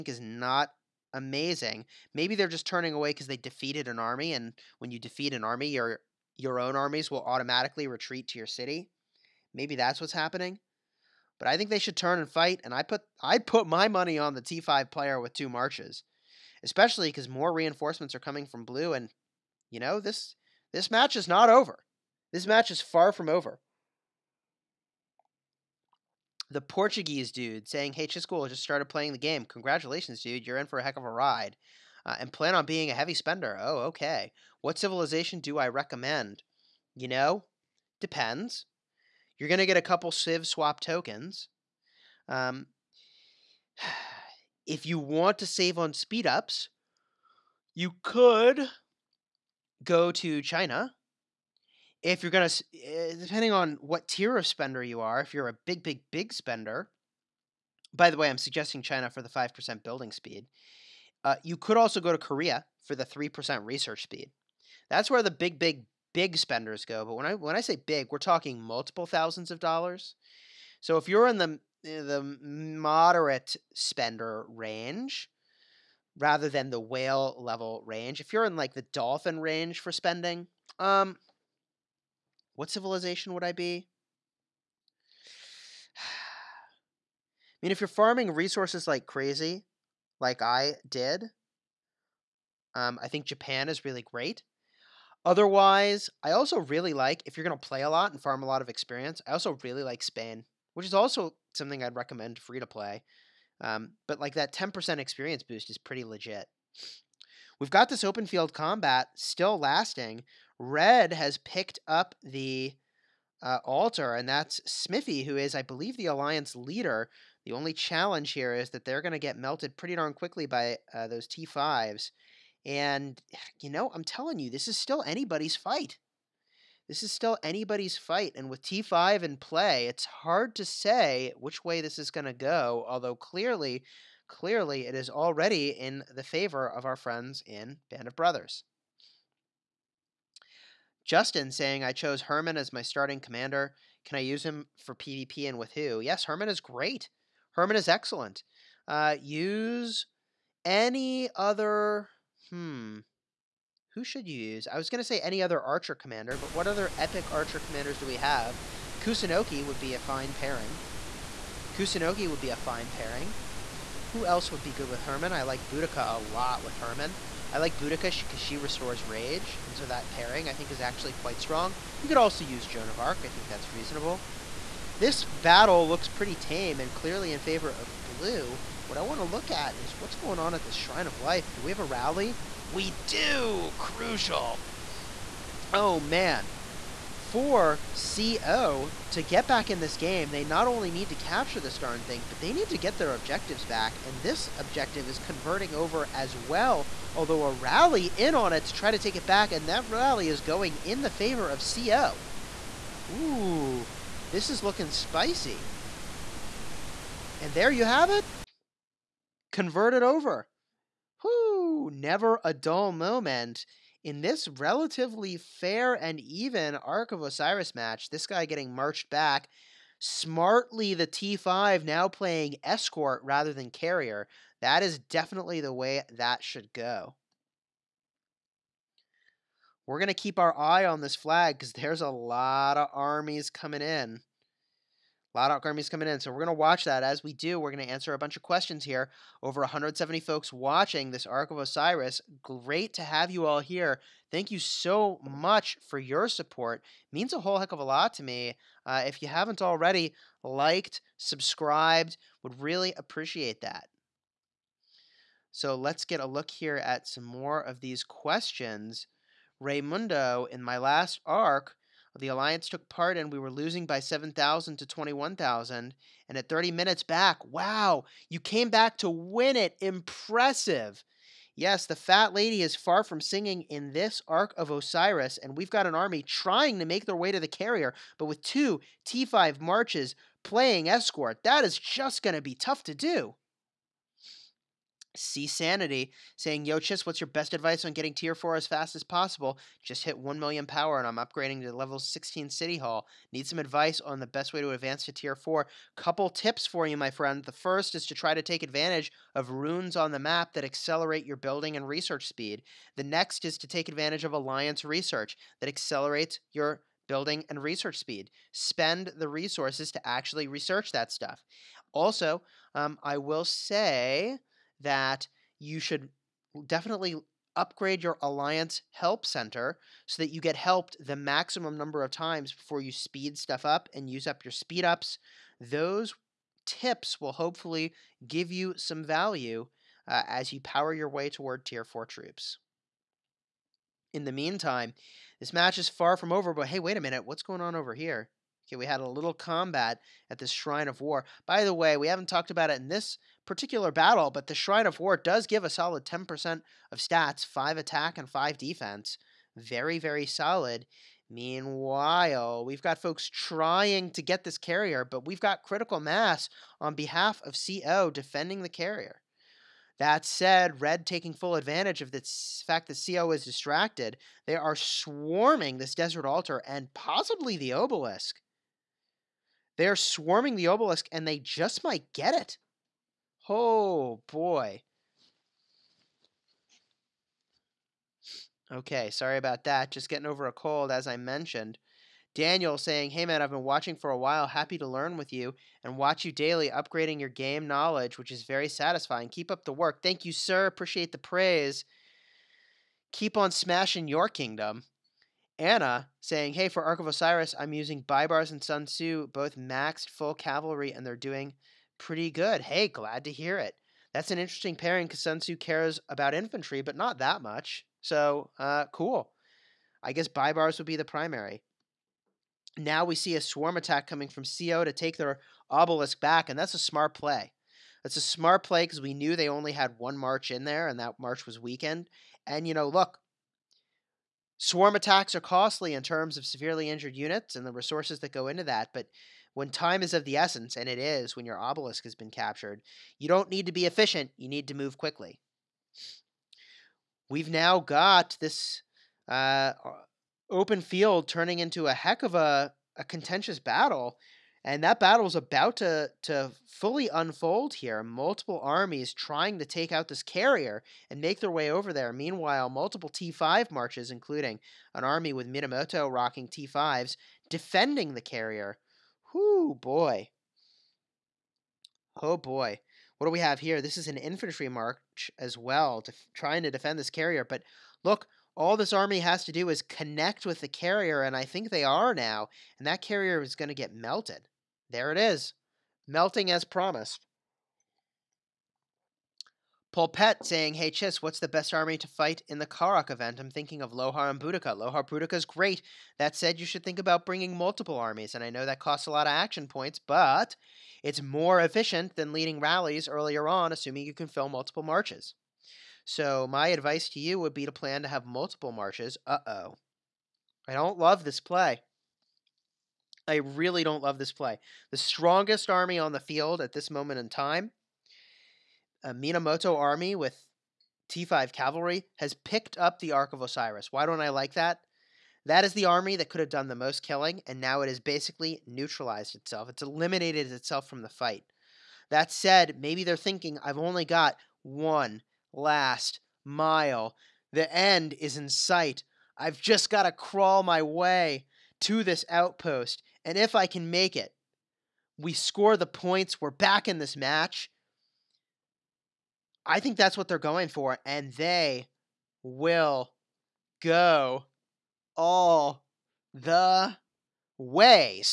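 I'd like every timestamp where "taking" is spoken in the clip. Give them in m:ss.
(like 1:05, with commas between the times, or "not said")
6:01.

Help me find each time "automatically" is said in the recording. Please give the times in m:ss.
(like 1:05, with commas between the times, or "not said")
0:07.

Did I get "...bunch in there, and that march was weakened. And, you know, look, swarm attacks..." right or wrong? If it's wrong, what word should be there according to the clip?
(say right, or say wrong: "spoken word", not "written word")
wrong: "march", not "bunch".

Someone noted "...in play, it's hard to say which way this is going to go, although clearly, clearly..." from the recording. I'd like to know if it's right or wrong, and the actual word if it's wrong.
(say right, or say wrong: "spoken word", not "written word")
right.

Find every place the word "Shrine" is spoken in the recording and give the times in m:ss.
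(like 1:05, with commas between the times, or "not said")
3:00, 5:40, 5:44.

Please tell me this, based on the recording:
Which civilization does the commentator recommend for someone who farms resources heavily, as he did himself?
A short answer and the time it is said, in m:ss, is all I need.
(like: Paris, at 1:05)
Japan, at 1:33.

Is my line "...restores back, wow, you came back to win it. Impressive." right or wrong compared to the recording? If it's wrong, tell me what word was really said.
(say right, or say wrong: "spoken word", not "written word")
wrong: "minutes", not "restores".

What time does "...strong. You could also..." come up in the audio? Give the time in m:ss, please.
2:51.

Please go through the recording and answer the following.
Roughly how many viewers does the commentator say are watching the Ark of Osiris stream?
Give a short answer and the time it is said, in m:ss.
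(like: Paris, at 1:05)
Over 170, at 3:59.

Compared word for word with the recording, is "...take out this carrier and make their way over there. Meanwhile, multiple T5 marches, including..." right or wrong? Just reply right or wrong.
right.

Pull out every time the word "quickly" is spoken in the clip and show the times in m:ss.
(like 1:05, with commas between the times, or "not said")
2:00, 7:14.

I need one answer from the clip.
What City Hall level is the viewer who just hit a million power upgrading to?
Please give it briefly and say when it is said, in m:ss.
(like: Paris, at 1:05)
16, at 4:51.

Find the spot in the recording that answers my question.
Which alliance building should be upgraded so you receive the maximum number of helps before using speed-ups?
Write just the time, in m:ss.
5:18.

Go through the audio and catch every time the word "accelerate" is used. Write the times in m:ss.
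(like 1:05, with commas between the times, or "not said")
5:00, 5:05.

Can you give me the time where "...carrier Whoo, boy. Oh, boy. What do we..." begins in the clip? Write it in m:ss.
7:38.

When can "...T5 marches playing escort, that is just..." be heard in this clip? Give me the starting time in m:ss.
4:39.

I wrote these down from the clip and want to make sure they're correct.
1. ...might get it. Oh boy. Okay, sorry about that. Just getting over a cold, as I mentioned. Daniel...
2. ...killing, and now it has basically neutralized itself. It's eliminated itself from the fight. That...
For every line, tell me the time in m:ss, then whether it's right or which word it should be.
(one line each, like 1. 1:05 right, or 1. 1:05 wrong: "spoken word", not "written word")
1. 6:11 right
2. 8:37 right.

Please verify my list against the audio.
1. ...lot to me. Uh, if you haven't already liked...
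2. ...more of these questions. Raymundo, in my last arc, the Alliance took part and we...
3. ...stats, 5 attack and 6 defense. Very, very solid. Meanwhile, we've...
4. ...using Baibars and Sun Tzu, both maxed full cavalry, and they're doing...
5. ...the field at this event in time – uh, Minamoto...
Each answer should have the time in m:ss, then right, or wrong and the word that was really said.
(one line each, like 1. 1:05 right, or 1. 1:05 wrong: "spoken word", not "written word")
1. 4:07 right
2. 4:17 right
3. 5:46 wrong: "5", not "6"
4. 6:37 right
5. 8:26 wrong: "moment", not "event".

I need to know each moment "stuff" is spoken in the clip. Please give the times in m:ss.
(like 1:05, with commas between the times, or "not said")
5:11, 5:23.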